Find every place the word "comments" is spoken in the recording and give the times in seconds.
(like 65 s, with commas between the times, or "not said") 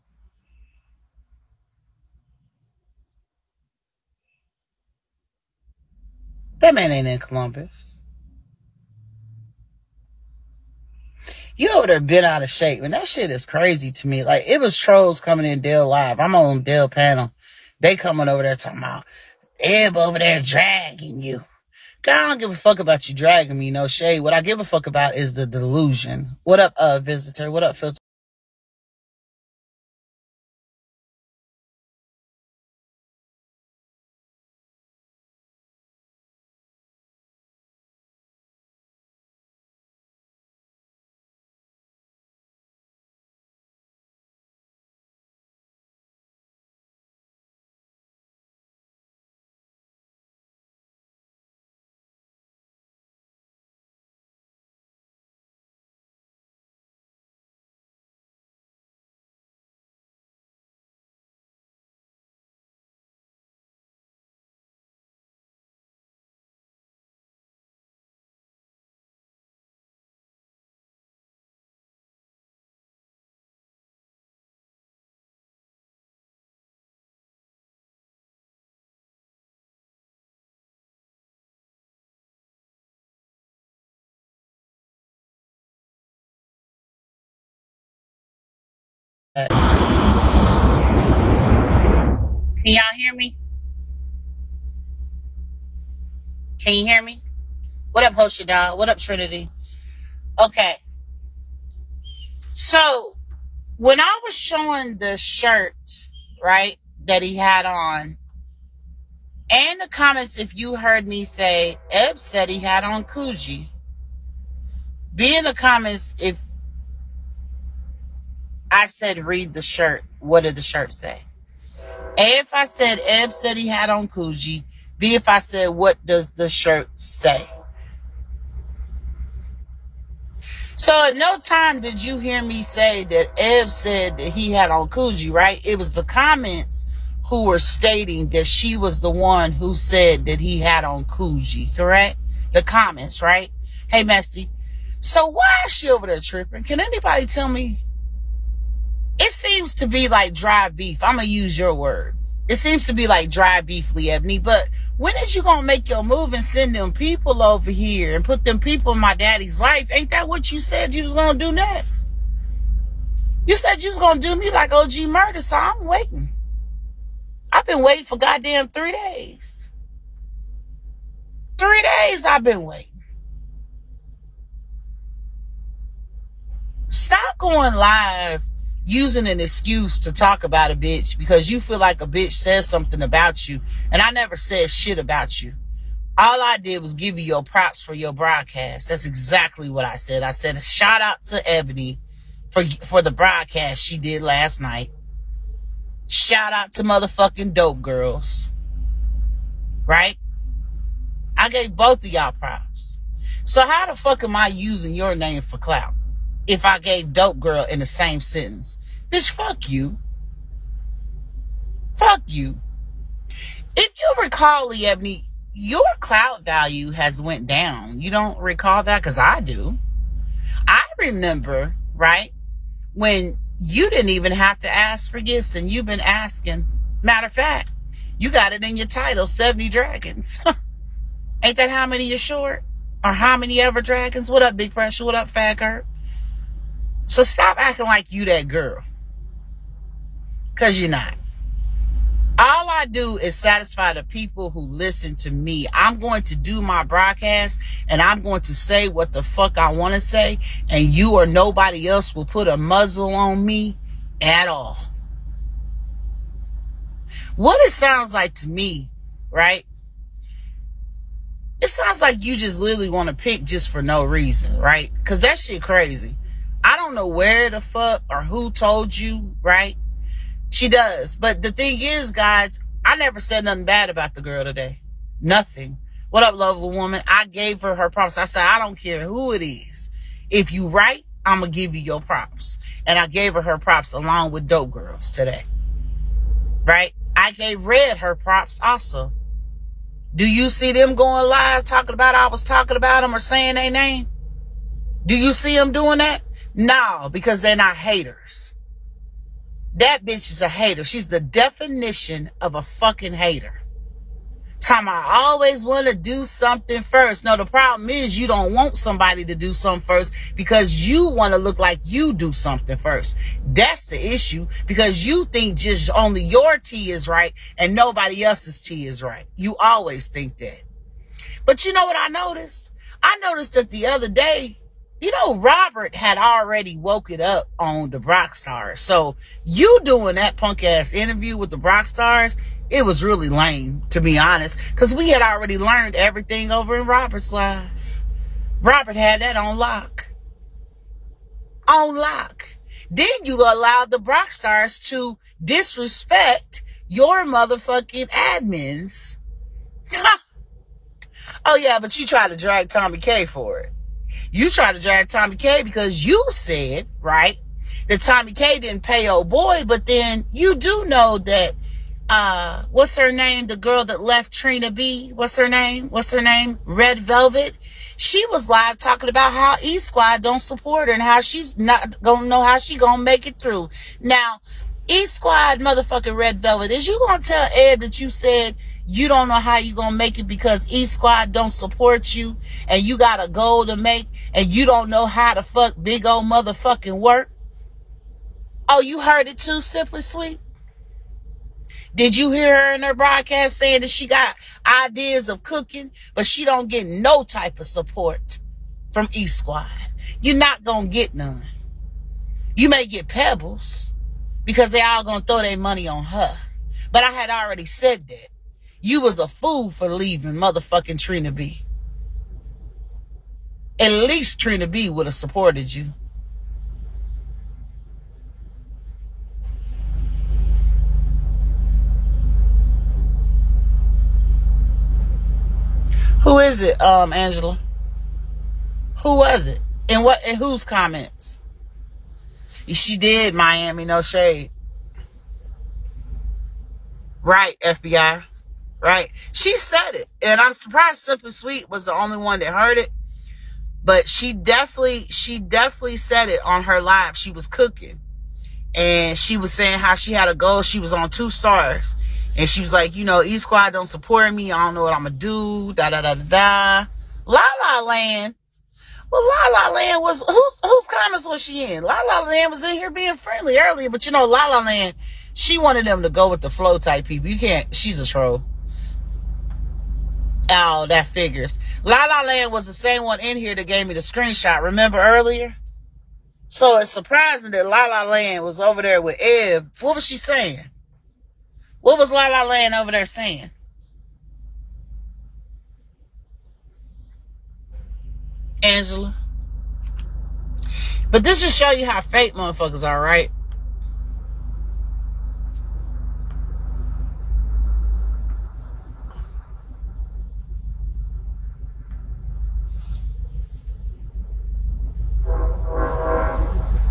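109 s, 115 s, 136 s, 142 s, 430 s, 460 s.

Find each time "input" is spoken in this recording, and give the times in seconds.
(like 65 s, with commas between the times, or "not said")
not said.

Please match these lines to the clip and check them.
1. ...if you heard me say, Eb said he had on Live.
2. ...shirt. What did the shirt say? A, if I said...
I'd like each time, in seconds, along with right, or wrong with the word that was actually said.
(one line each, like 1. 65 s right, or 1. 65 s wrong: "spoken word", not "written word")
1. 110 s wrong: "Coogi", not "Live"
2. 119 s right.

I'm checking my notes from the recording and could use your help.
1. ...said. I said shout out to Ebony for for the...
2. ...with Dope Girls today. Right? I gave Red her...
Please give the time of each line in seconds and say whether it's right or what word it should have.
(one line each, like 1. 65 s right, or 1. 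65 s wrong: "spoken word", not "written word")
1. 189 s right
2. 284 s right.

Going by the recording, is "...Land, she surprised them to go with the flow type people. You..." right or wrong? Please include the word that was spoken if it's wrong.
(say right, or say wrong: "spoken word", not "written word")
wrong: "wanted", not "surprised".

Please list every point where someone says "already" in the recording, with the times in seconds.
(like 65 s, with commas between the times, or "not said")
326 s, 335 s, 407 s.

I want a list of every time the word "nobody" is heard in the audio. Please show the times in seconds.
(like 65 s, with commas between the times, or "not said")
251 s, 317 s.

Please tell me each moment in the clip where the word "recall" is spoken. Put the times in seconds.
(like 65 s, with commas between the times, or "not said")
214 s, 218 s.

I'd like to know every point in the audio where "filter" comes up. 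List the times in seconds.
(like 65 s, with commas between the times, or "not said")
27 s.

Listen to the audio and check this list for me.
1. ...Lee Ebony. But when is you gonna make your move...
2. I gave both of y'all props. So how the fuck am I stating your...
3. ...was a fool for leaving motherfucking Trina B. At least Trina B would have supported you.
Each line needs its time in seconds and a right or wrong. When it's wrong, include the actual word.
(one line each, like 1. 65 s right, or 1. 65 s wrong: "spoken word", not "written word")
1. 153 s right
2. 201 s wrong: "using", not "stating"
3. 409 s right.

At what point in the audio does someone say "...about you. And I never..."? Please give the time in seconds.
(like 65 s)
183 s.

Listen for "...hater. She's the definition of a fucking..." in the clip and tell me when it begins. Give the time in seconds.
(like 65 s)
300 s.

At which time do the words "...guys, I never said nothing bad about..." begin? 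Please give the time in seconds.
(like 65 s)
272 s.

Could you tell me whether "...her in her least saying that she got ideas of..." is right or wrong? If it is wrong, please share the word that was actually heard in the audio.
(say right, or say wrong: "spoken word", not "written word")
wrong: "broadcast", not "least".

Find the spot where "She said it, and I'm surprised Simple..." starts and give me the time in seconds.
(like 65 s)
439 s.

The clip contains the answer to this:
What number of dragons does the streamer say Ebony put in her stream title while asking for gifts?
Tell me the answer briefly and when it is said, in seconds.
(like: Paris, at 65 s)
70, at 229 s.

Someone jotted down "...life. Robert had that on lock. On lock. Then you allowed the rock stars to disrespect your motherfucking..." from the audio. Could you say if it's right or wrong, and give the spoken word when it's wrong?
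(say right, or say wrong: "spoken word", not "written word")
right.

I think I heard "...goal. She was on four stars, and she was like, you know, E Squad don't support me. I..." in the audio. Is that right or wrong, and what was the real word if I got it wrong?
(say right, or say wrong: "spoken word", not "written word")
wrong: "two", not "four".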